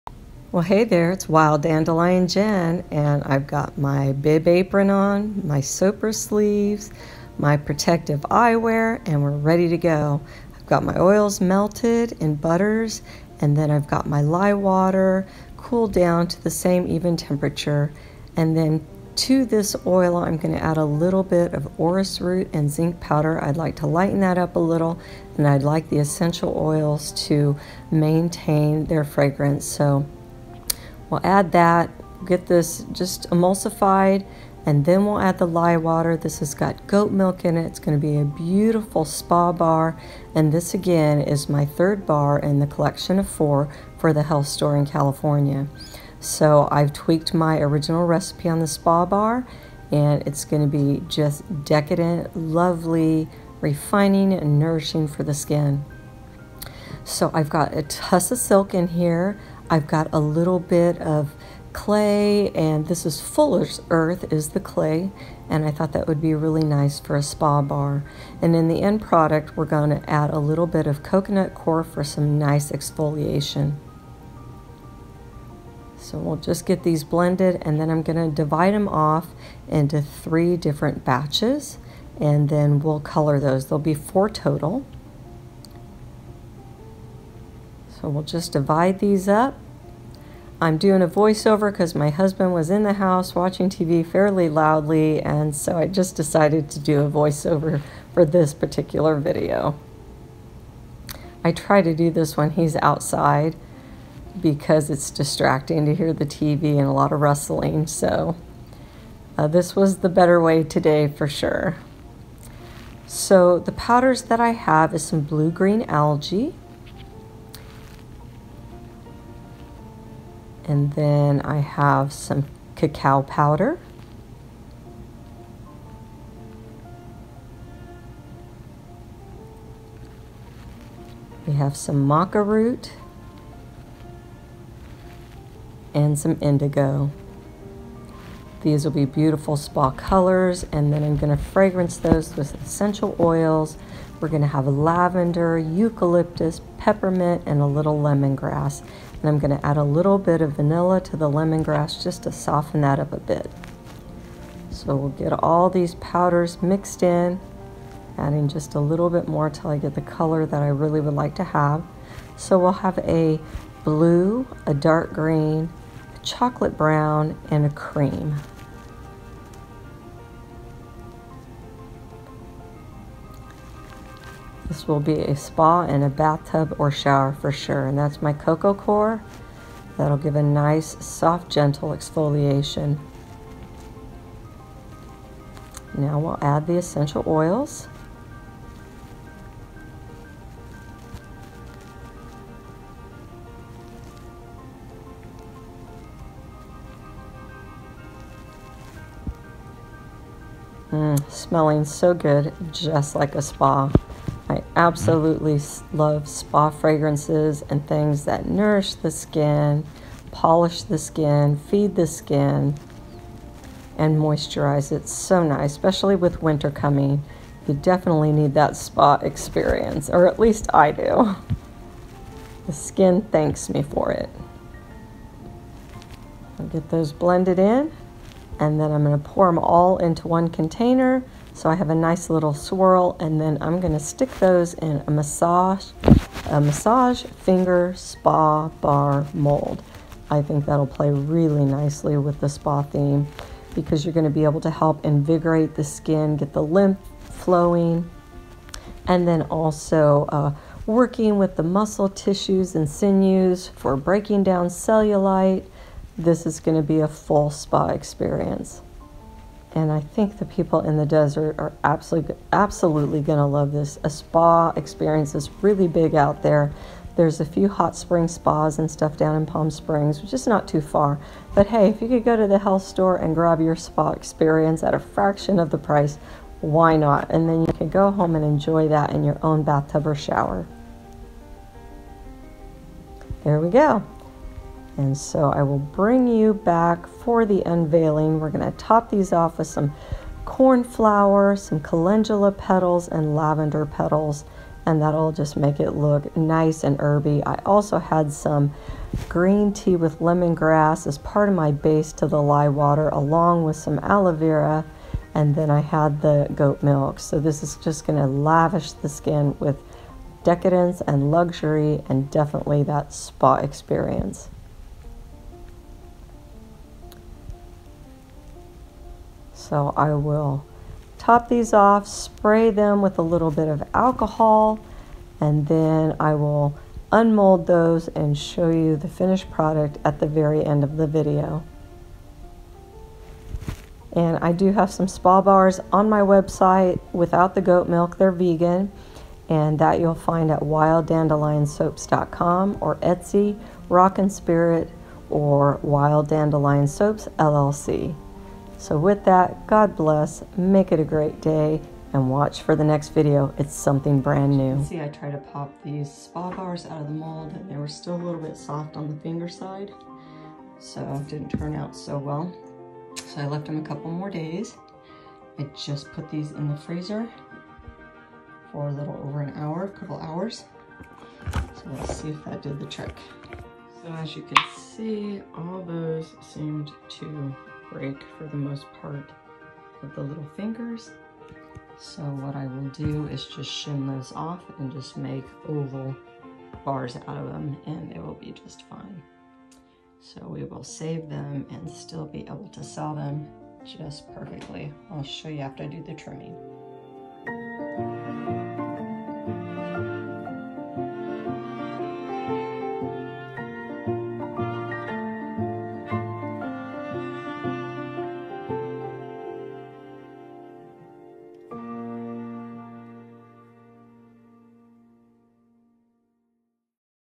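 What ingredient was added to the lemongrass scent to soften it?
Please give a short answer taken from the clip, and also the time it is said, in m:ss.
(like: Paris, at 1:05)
vanilla, at 2:30.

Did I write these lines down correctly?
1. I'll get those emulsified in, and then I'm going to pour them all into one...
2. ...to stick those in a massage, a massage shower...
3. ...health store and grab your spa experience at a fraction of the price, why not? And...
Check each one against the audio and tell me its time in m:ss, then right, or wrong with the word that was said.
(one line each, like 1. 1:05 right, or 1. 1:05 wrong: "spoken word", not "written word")
1. 3:46 wrong: "blended", not "emulsified"
2. 3:53 wrong: "finger", not "shower"
3. 4:32 right.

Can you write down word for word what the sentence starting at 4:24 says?
A spa experience is really big out there.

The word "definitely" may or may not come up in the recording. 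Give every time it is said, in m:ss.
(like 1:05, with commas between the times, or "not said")
3:37, 5:12.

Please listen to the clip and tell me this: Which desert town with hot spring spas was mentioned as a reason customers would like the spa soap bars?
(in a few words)
Palm Springs.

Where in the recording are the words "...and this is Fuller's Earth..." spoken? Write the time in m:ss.
1:02.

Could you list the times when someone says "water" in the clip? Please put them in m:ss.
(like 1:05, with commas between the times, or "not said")
0:14, 0:35, 5:02.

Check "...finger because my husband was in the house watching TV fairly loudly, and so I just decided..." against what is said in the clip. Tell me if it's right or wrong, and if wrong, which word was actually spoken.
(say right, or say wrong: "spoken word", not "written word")
wrong: "voiceover", not "finger".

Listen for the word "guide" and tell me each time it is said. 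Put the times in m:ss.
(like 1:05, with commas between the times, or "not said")
not said.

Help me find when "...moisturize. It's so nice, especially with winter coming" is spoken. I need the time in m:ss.
3:34.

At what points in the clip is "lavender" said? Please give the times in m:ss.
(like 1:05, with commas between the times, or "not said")
2:24, 4:53.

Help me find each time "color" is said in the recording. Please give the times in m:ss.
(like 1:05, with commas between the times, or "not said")
1:22, 2:19, 2:40.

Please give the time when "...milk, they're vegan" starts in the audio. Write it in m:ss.
5:37.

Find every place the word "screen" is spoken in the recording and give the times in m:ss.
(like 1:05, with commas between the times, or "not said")
not said.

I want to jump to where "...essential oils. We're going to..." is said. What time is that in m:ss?
2:22.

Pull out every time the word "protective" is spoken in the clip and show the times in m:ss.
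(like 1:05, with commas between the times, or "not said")
0:07.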